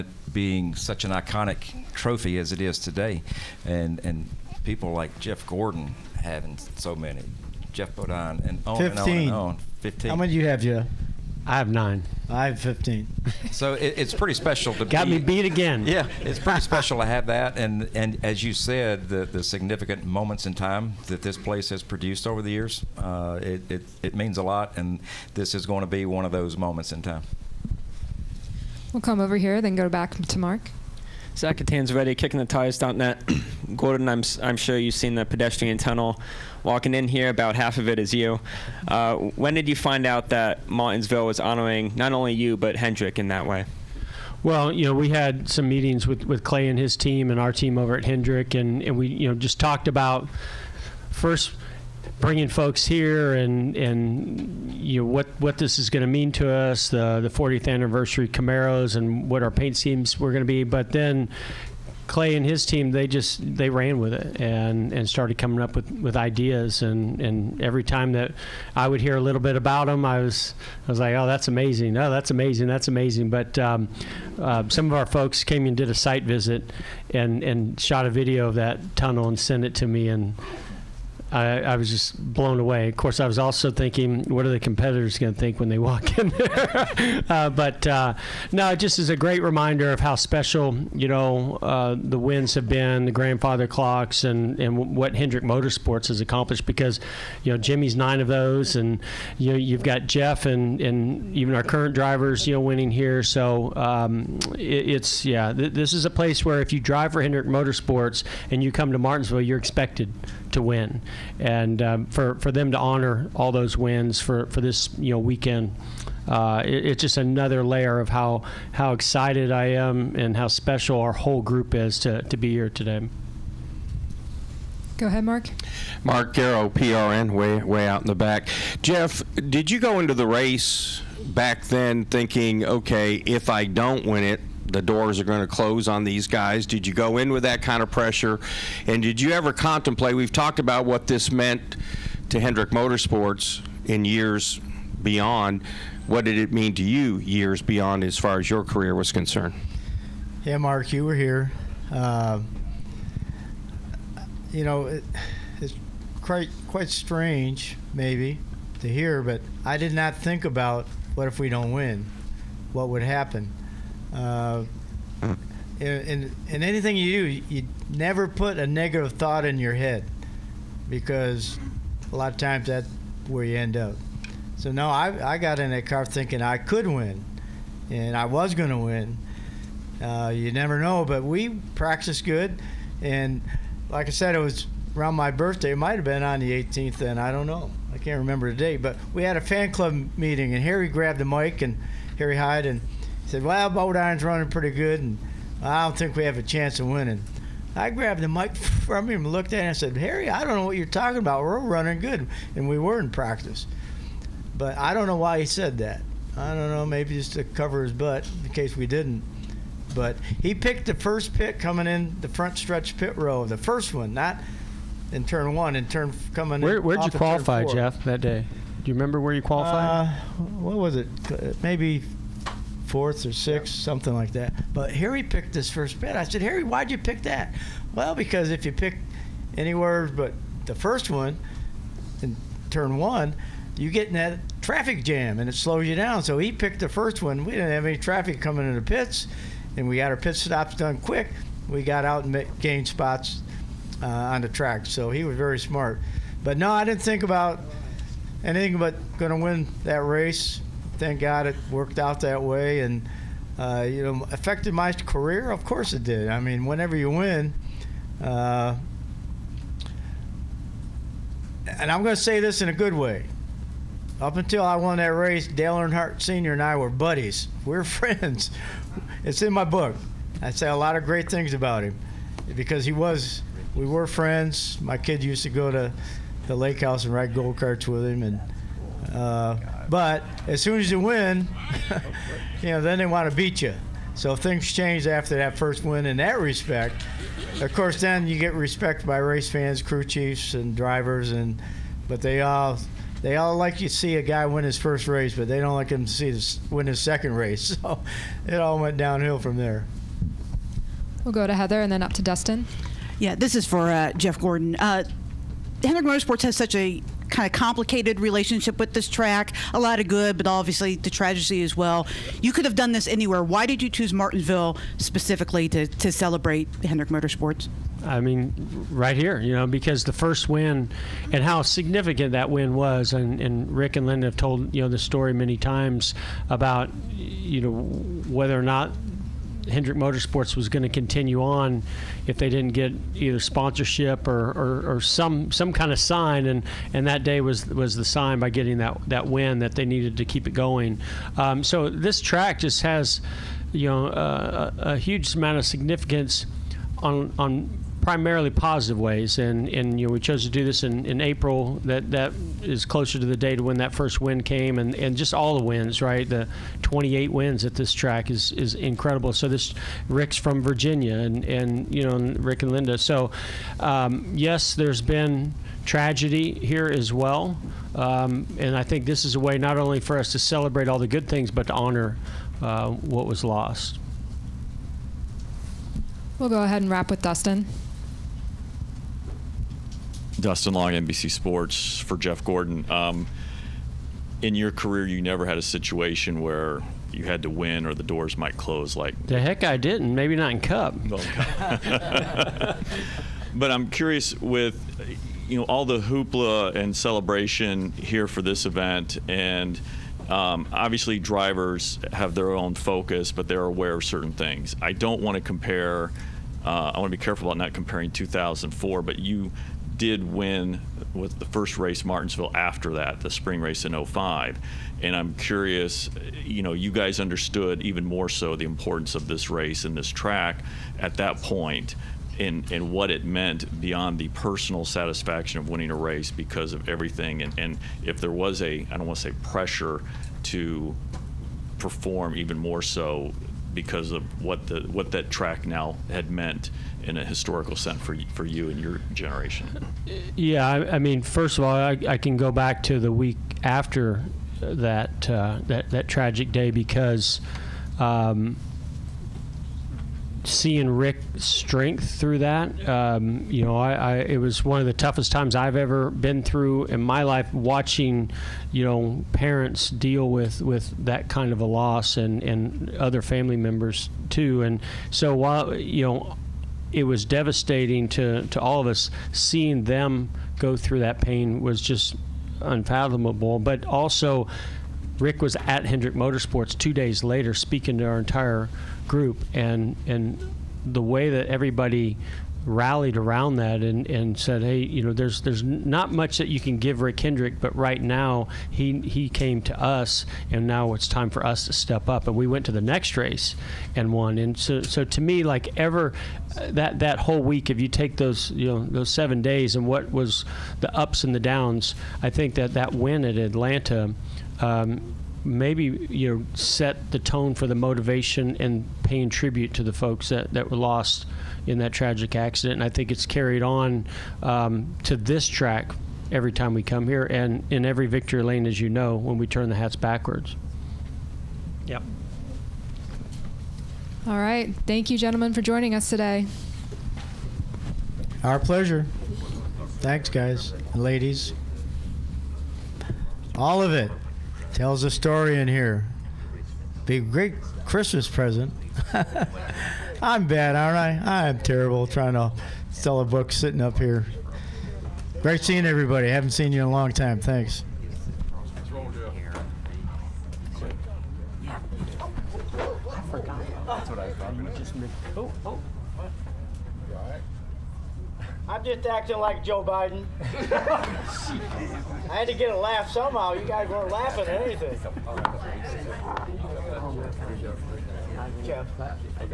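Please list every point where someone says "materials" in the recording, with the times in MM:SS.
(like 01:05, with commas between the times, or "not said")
not said.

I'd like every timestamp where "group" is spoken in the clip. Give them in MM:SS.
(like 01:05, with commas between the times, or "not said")
02:01, 07:59.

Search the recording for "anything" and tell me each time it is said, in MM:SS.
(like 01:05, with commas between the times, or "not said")
02:46, 04:08, 09:24.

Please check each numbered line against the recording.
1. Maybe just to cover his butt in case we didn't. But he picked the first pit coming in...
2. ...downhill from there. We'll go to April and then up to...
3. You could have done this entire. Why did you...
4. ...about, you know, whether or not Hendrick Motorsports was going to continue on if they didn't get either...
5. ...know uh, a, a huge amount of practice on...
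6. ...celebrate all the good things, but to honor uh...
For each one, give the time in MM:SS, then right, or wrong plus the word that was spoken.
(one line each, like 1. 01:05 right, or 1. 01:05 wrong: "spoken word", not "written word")
1. 03:26 right
2. 04:58 wrong: "Heather", not "April"
3. 05:12 wrong: "anywhere", not "entire"
4. 05:26 right
5. 05:43 wrong: "significance", not "practice"
6. 06:10 right.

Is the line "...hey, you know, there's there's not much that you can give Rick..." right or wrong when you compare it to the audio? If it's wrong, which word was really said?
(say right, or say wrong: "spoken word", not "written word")
right.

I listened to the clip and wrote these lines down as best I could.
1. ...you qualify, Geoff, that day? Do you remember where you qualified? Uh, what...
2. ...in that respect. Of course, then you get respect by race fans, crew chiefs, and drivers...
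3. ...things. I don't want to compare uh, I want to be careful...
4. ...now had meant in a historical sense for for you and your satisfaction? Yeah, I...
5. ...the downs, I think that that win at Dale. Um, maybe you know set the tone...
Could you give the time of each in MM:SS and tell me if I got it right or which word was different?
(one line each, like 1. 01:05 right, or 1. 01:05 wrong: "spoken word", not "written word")
1. 03:37 right
2. 04:46 right
3. 06:44 right
4. 07:15 wrong: "generation", not "satisfaction"
5. 08:21 wrong: "Atlanta", not "Dale".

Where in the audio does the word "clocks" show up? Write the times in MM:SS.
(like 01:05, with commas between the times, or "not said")
01:33.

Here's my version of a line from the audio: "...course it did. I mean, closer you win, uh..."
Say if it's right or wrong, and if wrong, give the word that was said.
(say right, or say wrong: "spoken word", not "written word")
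wrong: "whenever", not "closer".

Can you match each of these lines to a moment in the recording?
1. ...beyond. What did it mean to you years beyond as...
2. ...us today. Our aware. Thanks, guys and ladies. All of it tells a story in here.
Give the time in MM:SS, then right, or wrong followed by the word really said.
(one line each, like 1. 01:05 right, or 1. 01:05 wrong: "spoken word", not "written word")
1. 02:25 right
2. 08:45 wrong: "pleasure", not "aware".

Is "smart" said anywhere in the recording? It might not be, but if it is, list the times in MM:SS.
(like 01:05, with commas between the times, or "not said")
04:05.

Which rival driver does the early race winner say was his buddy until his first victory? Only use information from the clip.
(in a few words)
Dale Earnhardt Sr.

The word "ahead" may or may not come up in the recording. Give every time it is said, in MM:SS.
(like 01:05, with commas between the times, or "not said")
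02:05, 06:16.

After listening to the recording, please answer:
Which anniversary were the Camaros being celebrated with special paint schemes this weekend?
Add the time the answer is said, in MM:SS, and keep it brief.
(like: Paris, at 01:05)
40th, at 00:57.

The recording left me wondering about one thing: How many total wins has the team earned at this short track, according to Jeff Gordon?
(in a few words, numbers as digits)
28.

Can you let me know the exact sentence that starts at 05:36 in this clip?
And, and that day was was the sign by getting that that win that they needed to keep it going.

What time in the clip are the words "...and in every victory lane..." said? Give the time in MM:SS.
08:37.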